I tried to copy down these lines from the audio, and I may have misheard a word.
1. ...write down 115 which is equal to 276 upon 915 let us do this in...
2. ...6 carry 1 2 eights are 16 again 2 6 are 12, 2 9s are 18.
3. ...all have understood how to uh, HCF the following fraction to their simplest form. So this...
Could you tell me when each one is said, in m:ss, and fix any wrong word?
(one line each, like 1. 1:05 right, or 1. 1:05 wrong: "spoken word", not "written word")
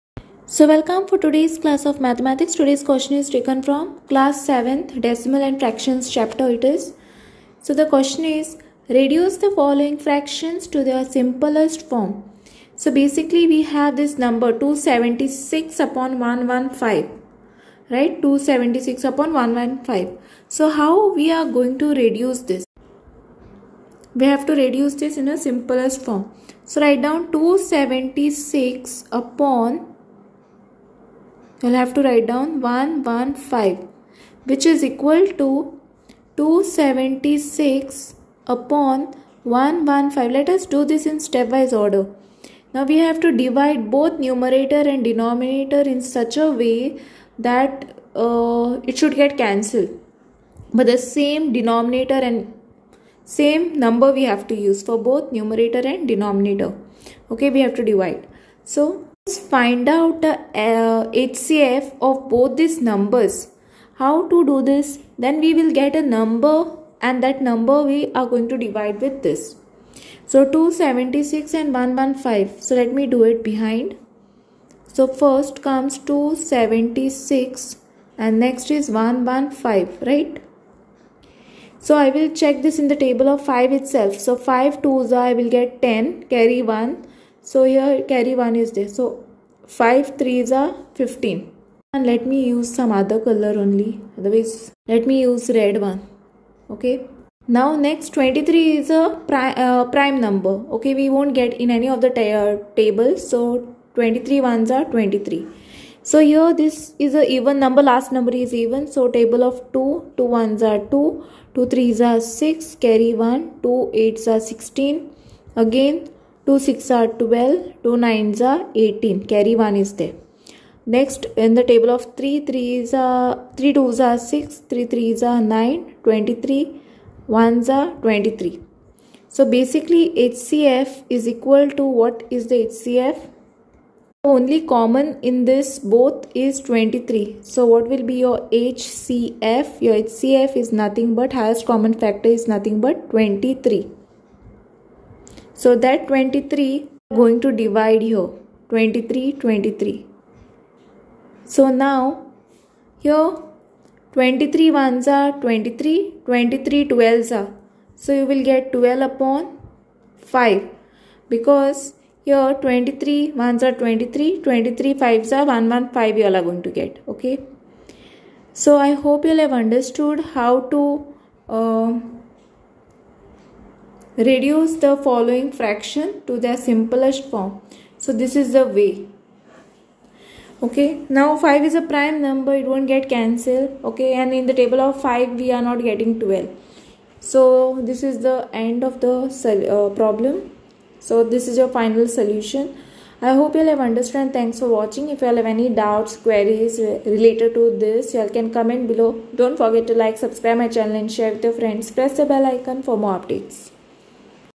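1. 0:32 wrong: "115", not "915"
2. 1:52 right
3. 2:49 wrong: "Reduce", not "HCF".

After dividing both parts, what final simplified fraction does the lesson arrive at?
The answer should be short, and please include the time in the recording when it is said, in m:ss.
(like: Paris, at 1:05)
12/5, at 2:38.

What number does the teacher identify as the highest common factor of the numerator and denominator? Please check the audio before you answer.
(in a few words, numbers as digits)
23.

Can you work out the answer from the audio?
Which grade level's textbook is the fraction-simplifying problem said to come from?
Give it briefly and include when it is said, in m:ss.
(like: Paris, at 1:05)
Class 7, at 0:04.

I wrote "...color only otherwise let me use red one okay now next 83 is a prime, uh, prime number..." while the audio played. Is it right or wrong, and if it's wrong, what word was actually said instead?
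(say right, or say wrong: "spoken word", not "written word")
wrong: "23", not "83".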